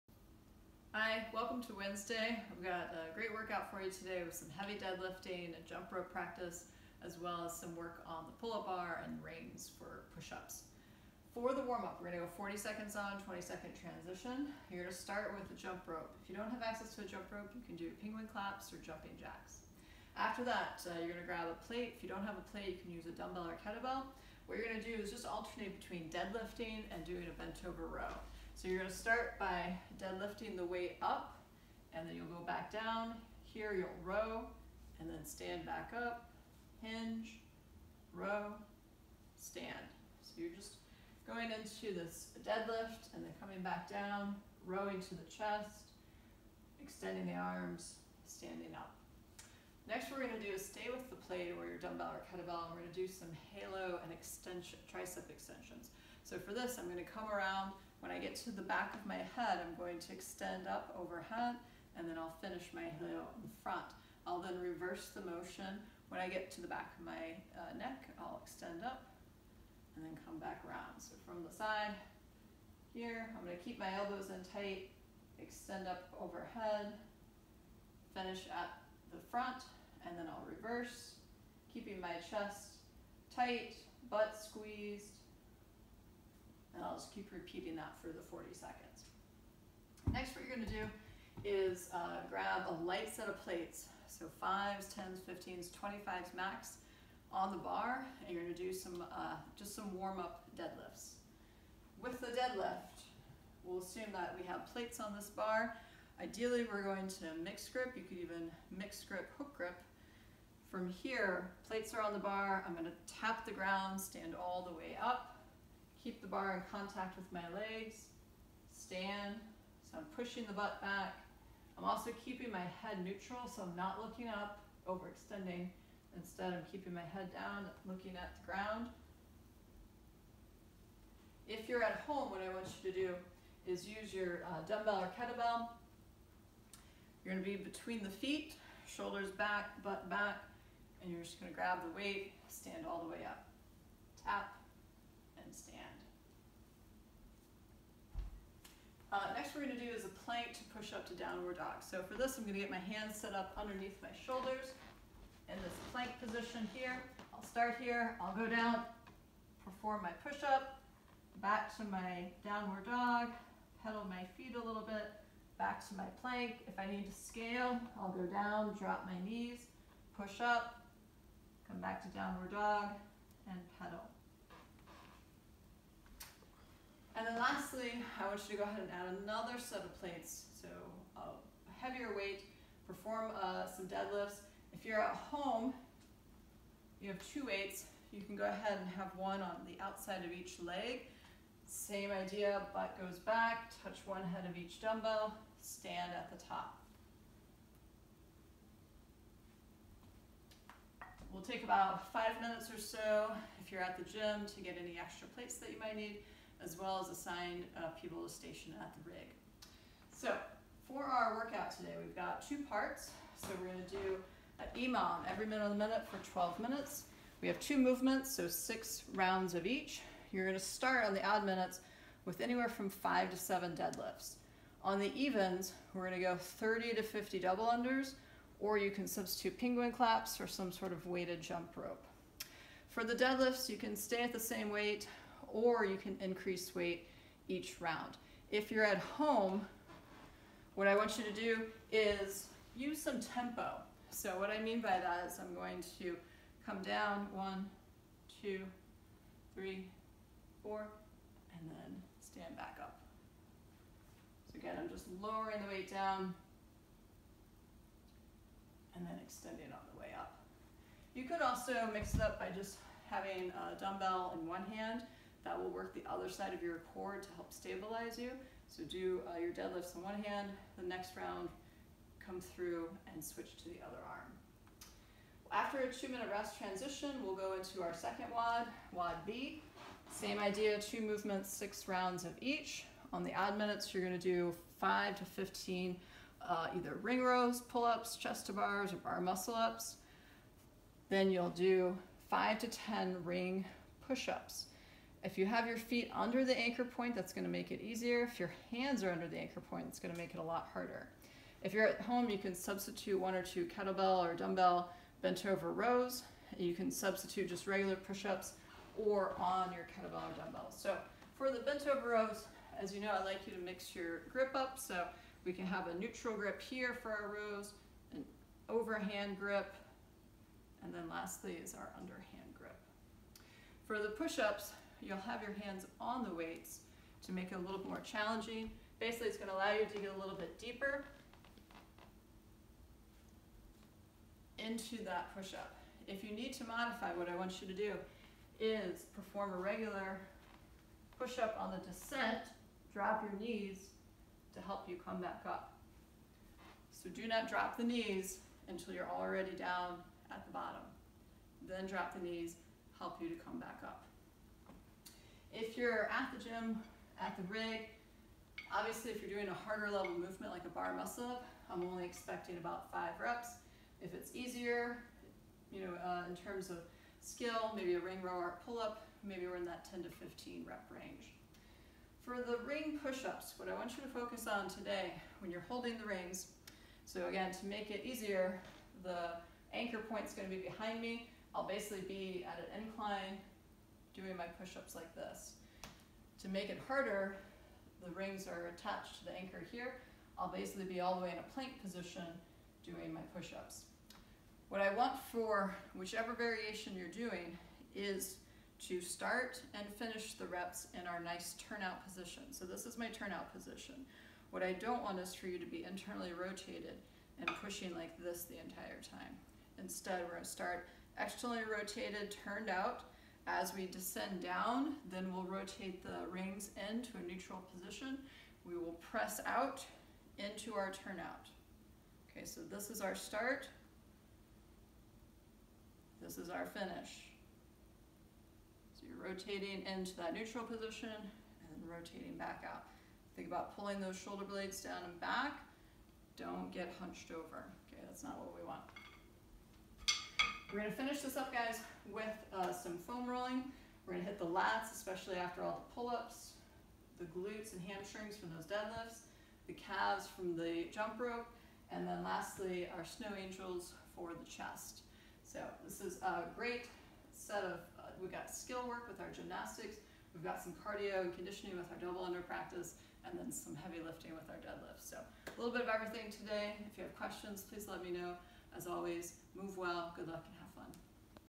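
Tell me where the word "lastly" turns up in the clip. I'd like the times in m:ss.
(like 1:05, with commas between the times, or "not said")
2:57, 5:21, 7:32.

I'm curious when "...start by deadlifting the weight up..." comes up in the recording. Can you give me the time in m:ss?
0:28.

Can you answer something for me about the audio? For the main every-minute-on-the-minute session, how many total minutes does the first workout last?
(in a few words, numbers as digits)
12 minutes.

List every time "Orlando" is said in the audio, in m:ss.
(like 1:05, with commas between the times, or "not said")
not said.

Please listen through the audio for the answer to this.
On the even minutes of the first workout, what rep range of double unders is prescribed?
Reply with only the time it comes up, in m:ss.
3:46.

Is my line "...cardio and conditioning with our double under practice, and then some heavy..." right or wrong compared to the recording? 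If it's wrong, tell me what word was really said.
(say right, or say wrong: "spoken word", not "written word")
right.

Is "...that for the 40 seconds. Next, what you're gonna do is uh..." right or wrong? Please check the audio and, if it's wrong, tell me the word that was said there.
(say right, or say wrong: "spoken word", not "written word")
right.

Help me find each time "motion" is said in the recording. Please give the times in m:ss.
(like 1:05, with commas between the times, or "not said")
1:05.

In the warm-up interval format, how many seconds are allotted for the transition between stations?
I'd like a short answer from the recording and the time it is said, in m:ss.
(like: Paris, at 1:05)
20 seconds, at 0:13.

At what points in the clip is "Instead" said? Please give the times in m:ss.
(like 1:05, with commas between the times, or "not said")
2:06, 6:49.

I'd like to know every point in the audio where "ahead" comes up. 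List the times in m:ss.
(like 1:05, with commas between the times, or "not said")
2:58, 3:08.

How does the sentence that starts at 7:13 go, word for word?
Think about pulling those shoulder blades down and back.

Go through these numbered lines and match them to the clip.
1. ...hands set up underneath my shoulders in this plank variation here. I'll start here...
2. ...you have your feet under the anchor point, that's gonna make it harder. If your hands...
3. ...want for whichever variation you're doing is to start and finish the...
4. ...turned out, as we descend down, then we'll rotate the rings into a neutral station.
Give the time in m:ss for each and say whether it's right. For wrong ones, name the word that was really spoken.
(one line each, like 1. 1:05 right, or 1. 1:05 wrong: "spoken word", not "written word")
1. 2:32 wrong: "position", not "variation"
2. 4:55 wrong: "easier", not "harder"
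3. 6:34 right
4. 6:52 wrong: "position", not "station".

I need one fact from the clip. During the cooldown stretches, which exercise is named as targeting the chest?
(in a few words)
snow angels.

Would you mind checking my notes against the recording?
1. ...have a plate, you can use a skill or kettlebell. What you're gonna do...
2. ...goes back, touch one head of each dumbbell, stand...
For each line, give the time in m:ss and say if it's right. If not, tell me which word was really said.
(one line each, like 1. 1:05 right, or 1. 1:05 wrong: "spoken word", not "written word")
1. 0:22 wrong: "dumbbell", not "skill"
2. 3:13 right.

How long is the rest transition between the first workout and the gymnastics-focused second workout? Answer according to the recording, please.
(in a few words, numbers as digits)
2 minutes.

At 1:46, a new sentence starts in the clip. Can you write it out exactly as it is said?
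Ideally, we're going to mix grip.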